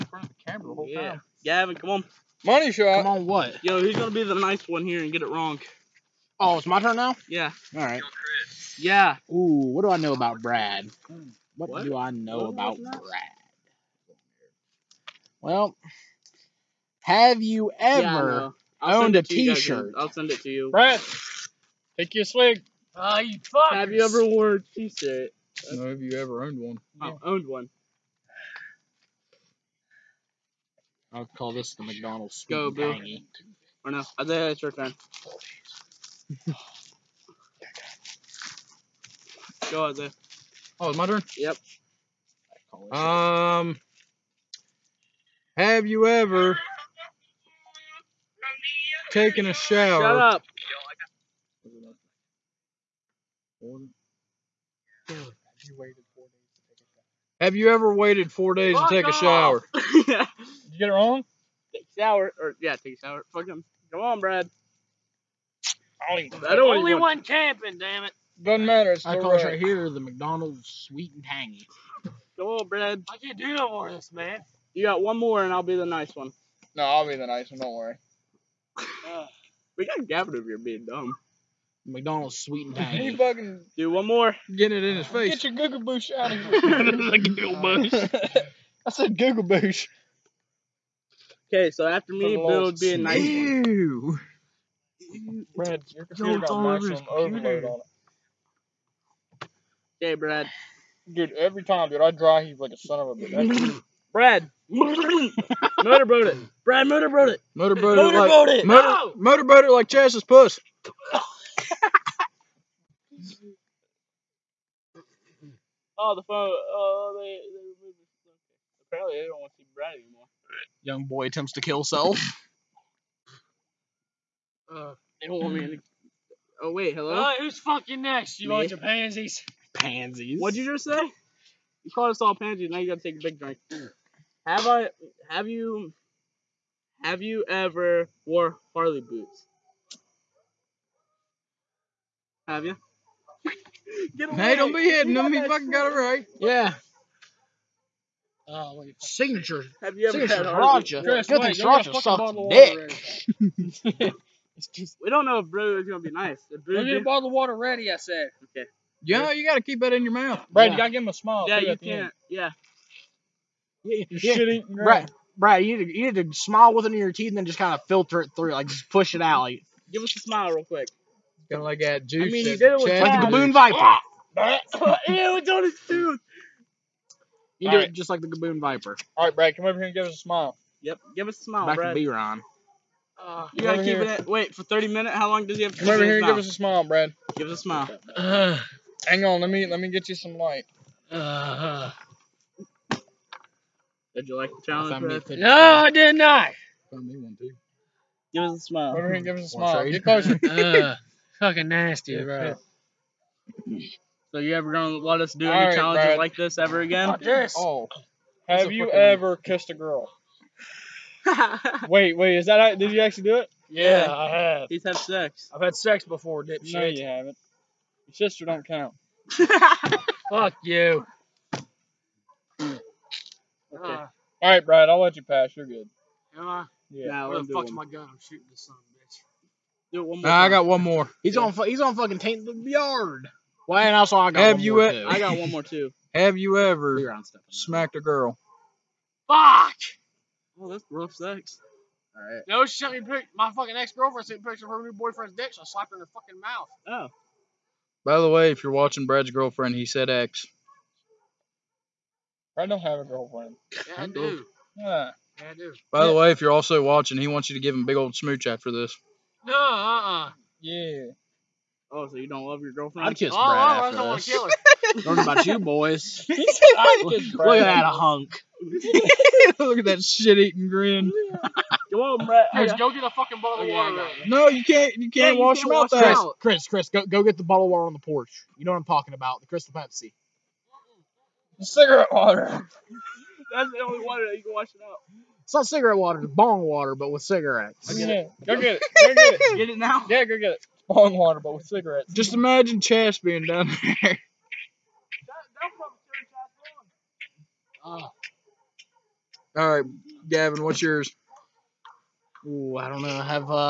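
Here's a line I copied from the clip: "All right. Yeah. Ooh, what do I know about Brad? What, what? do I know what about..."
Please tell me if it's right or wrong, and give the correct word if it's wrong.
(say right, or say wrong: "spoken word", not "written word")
right.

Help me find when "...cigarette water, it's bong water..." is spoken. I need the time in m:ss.
4:45.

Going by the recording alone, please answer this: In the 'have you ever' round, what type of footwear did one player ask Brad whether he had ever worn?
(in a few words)
Harley boots.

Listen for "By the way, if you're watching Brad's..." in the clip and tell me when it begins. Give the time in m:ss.
4:08.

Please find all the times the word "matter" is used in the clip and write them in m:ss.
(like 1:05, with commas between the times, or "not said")
1:08.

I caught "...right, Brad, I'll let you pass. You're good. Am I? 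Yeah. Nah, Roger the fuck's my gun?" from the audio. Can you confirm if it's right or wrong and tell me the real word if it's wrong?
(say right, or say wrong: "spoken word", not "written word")
wrong: "Where", not "Roger".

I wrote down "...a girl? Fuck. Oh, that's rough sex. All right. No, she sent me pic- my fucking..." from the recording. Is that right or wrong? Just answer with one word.
right.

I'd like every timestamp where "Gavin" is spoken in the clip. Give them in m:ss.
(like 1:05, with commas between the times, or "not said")
0:01, 1:20, 5:00.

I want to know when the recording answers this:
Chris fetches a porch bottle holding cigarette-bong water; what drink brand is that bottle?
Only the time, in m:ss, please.
4:39.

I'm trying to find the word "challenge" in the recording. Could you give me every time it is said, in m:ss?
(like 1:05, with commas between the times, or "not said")
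3:14, 3:25.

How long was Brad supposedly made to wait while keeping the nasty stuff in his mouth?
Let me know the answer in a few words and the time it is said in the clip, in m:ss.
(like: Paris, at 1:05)
30 minutes, at 3:04.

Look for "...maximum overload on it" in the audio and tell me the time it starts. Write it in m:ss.
1:36.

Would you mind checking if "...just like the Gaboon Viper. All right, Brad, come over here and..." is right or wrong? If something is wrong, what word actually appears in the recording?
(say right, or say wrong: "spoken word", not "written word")
right.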